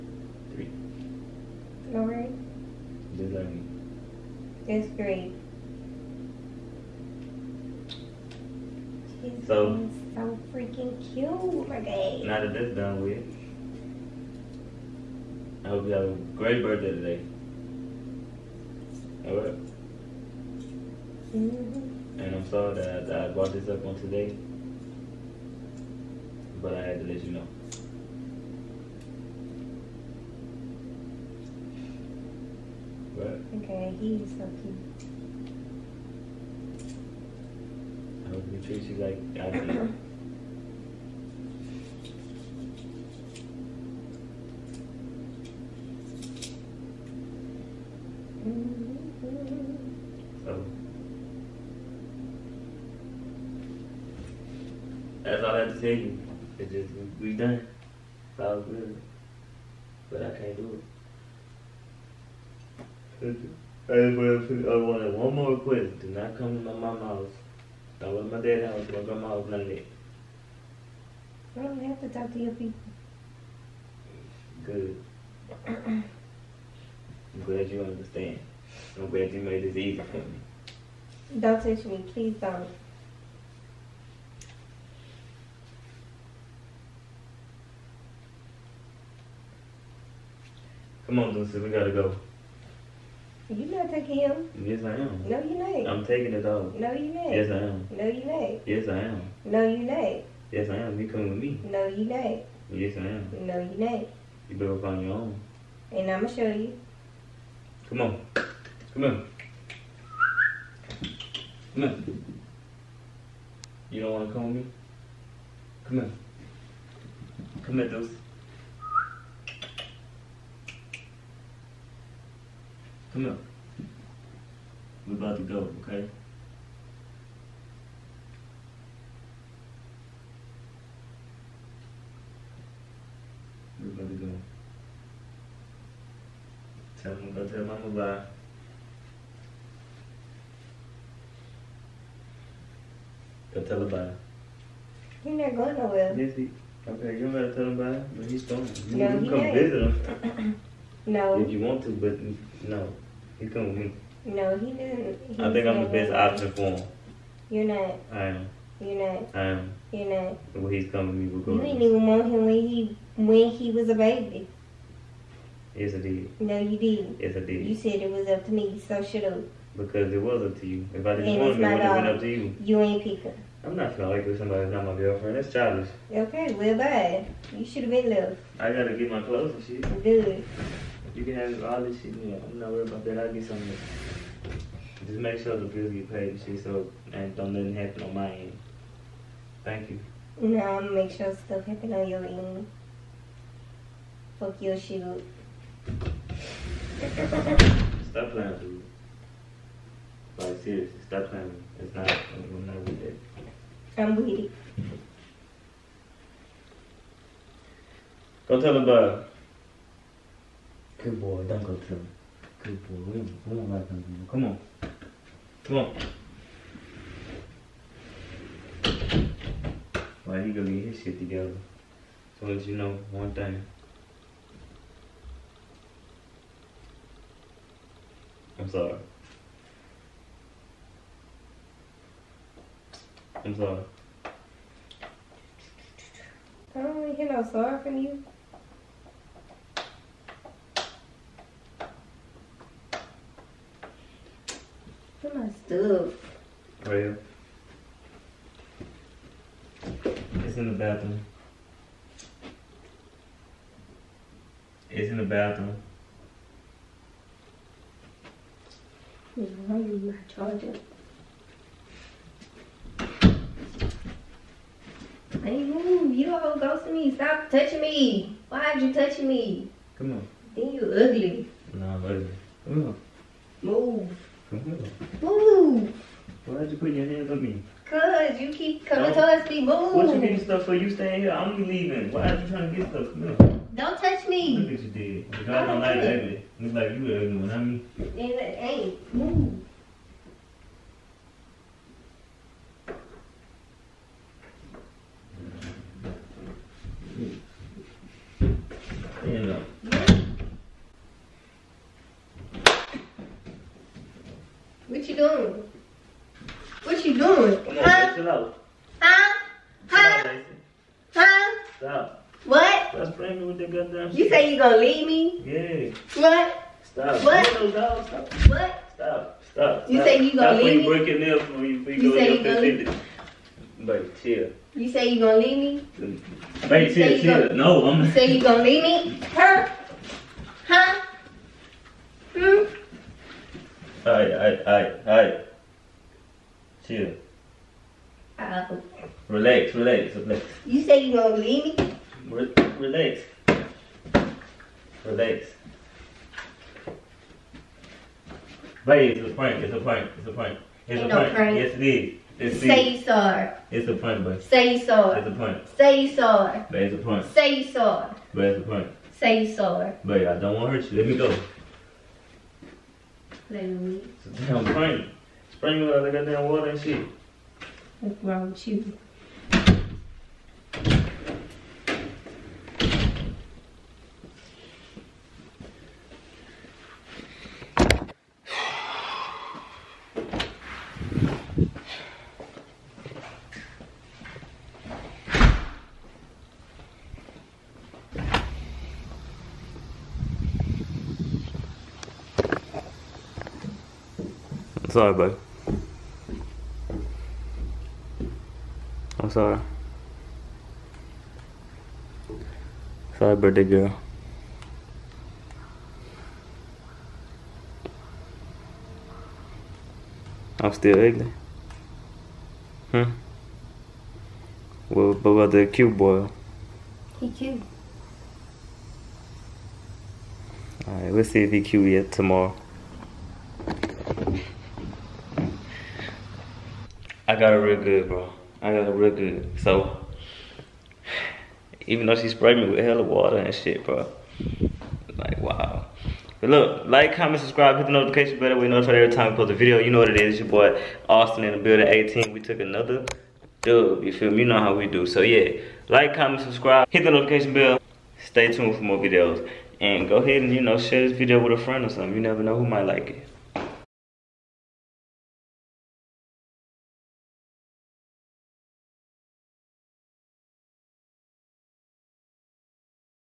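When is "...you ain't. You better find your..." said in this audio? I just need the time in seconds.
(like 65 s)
103 s.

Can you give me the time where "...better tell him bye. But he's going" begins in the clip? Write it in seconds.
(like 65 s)
147 s.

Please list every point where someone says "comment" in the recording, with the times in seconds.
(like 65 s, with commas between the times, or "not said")
437 s, 446 s.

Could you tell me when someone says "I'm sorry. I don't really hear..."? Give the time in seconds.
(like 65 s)
233 s.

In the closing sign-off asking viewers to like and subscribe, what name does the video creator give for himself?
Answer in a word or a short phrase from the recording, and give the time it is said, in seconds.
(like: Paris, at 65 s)
Austin, at 441 s.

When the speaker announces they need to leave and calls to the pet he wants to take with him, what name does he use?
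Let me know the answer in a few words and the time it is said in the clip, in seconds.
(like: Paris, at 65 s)
Lucy, at 91 s.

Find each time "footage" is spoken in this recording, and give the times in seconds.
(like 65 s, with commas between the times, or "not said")
not said.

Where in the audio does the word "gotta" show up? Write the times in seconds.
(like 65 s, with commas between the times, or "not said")
91 s, 178 s.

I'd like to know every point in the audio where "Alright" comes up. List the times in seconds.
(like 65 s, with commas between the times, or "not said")
19 s, 420 s.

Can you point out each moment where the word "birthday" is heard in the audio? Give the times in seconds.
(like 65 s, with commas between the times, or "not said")
16 s, 403 s.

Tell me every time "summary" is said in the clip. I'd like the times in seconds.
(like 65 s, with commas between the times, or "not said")
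not said.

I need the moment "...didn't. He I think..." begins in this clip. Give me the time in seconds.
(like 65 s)
154 s.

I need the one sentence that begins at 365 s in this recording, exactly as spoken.
Sprinkler, they got damn water and shit.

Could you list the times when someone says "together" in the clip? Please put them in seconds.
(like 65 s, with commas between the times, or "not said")
221 s.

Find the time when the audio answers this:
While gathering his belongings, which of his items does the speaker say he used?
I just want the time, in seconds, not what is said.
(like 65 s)
260 s.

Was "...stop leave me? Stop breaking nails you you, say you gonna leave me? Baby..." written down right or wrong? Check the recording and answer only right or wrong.
right.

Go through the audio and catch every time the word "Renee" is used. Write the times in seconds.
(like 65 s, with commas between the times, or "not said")
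11 s.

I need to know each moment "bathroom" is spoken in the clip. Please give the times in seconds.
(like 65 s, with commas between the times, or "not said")
250 s, 255 s.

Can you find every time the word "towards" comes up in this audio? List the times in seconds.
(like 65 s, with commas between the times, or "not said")
279 s.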